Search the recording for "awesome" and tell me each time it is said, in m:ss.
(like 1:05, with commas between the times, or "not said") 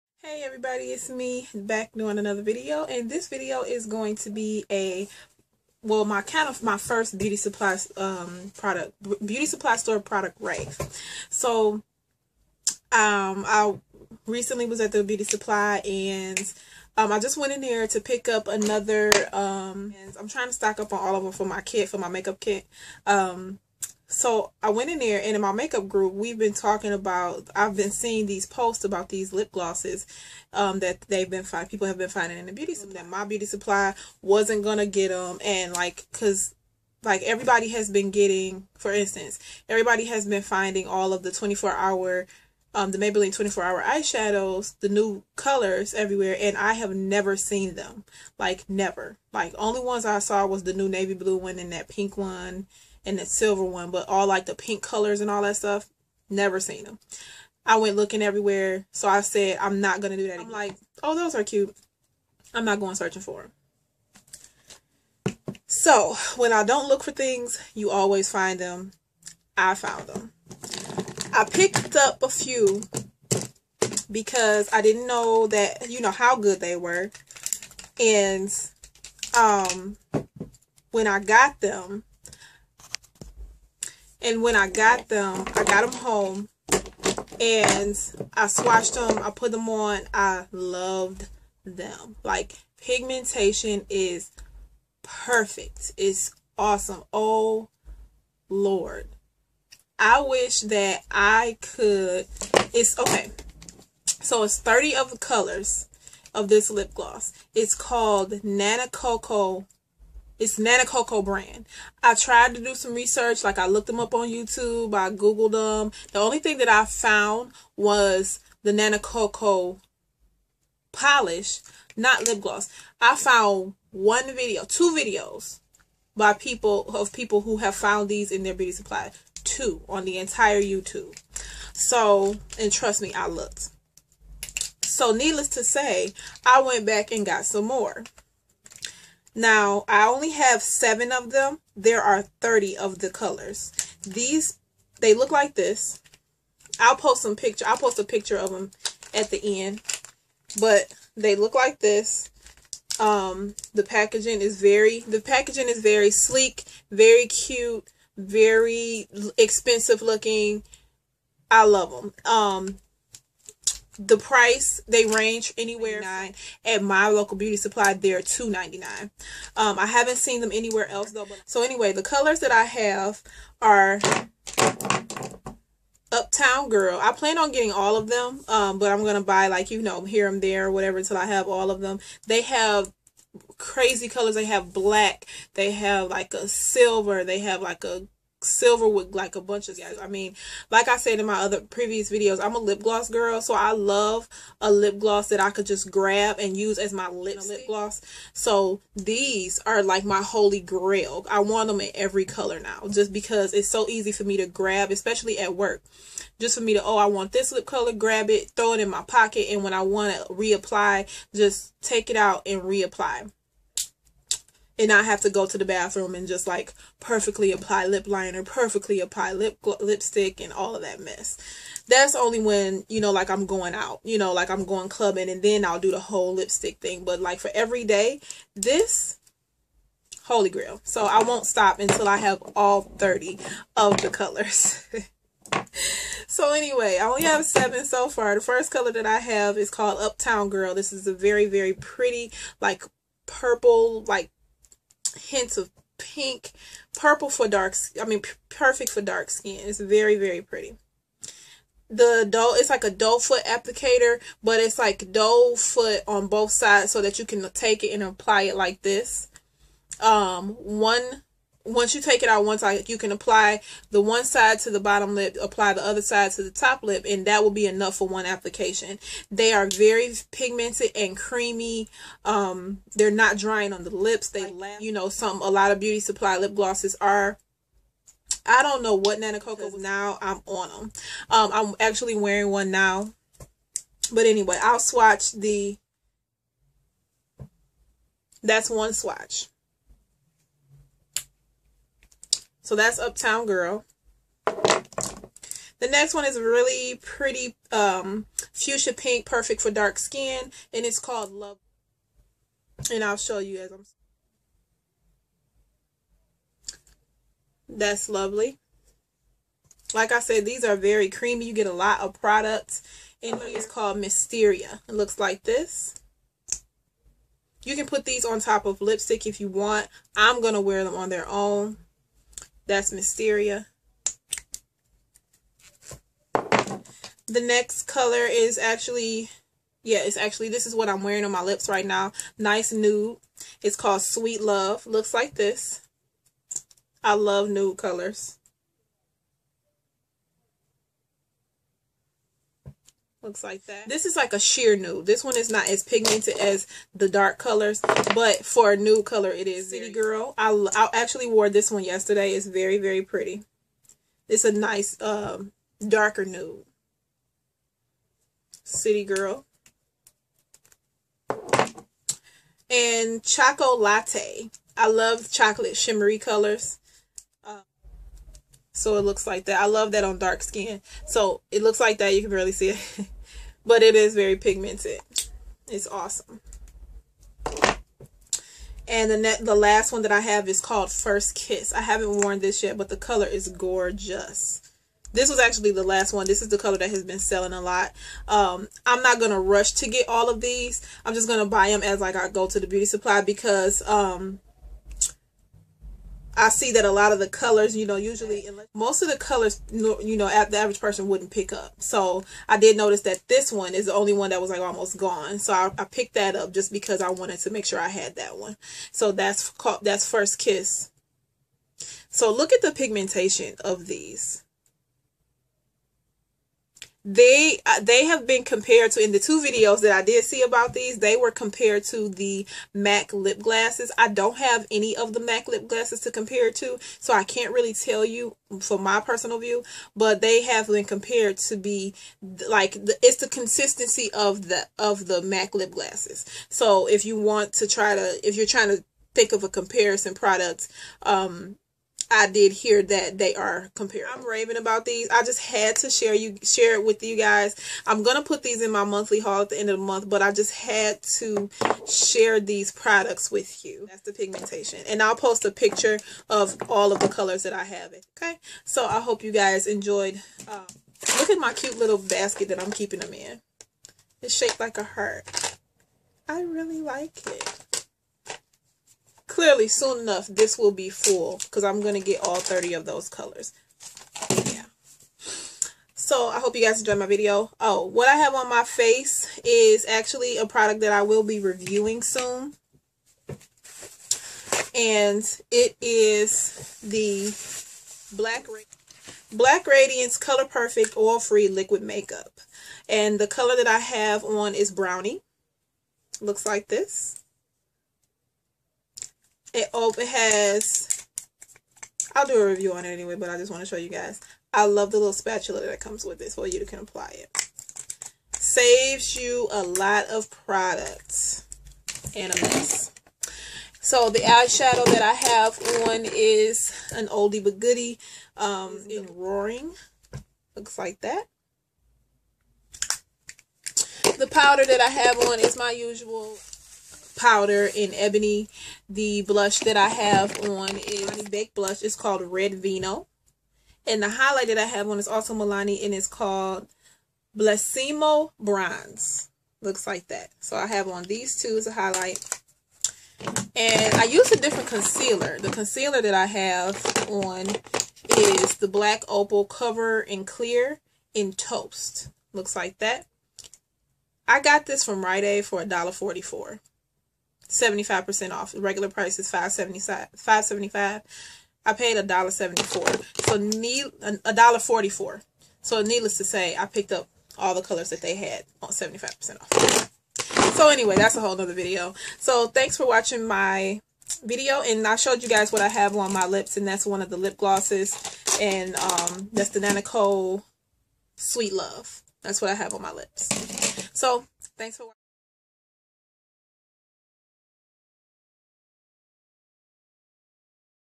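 1:36, 6:15.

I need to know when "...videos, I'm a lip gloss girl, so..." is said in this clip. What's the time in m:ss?
3:12.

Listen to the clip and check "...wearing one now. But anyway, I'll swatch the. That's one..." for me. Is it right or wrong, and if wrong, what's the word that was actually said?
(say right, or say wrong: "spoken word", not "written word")
right.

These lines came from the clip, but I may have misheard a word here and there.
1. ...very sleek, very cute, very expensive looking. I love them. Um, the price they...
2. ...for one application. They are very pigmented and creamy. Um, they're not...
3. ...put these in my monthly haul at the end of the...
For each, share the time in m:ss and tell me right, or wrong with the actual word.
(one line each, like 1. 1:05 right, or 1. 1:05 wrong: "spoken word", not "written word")
1. 2:35 right
2. 4:27 right
3. 7:28 right.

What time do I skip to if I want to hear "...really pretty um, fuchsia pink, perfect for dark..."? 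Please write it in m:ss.
4:56.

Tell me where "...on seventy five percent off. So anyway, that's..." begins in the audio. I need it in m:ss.
9:28.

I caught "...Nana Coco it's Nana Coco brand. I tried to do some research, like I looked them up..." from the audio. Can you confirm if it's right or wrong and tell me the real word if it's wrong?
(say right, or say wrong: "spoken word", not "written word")
right.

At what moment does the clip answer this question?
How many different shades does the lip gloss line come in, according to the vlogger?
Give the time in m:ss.
1:44.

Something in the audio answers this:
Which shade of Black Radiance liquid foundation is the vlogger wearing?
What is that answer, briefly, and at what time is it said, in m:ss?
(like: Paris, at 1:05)
Brownie, at 8:13.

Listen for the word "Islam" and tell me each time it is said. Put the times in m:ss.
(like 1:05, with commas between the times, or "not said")
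not said.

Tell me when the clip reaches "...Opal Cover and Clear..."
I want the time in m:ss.
9:09.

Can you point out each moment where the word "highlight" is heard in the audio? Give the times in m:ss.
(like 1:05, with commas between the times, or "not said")
8:54, 9:01.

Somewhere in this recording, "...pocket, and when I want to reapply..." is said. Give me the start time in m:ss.
3:29.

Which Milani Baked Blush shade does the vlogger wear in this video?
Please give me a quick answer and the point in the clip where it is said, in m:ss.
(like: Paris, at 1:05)
Red Vino, at 8:51.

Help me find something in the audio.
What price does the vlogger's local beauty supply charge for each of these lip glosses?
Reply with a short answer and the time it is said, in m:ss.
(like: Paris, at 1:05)
$2.99, at 2:48.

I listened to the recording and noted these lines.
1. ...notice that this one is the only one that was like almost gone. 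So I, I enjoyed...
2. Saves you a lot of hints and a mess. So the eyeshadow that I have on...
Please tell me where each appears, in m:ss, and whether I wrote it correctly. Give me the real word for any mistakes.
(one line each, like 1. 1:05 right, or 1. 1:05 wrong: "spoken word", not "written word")
1. 6:42 wrong: "picked", not "enjoyed"
2. 8:28 wrong: "products", not "hints".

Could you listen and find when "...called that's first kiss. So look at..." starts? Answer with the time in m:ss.
6:49.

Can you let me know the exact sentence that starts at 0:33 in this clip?
That my beauty supply wasn't going to get them.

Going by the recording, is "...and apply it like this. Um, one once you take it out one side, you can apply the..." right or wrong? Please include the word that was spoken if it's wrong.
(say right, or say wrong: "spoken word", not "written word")
right.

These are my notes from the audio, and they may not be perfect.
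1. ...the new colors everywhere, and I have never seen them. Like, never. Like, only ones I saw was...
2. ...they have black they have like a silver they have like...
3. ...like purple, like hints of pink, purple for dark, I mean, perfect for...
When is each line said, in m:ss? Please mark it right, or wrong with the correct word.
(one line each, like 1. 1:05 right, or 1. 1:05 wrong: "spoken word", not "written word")
1. 0:44 right
2. 3:04 right
3. 4:02 right.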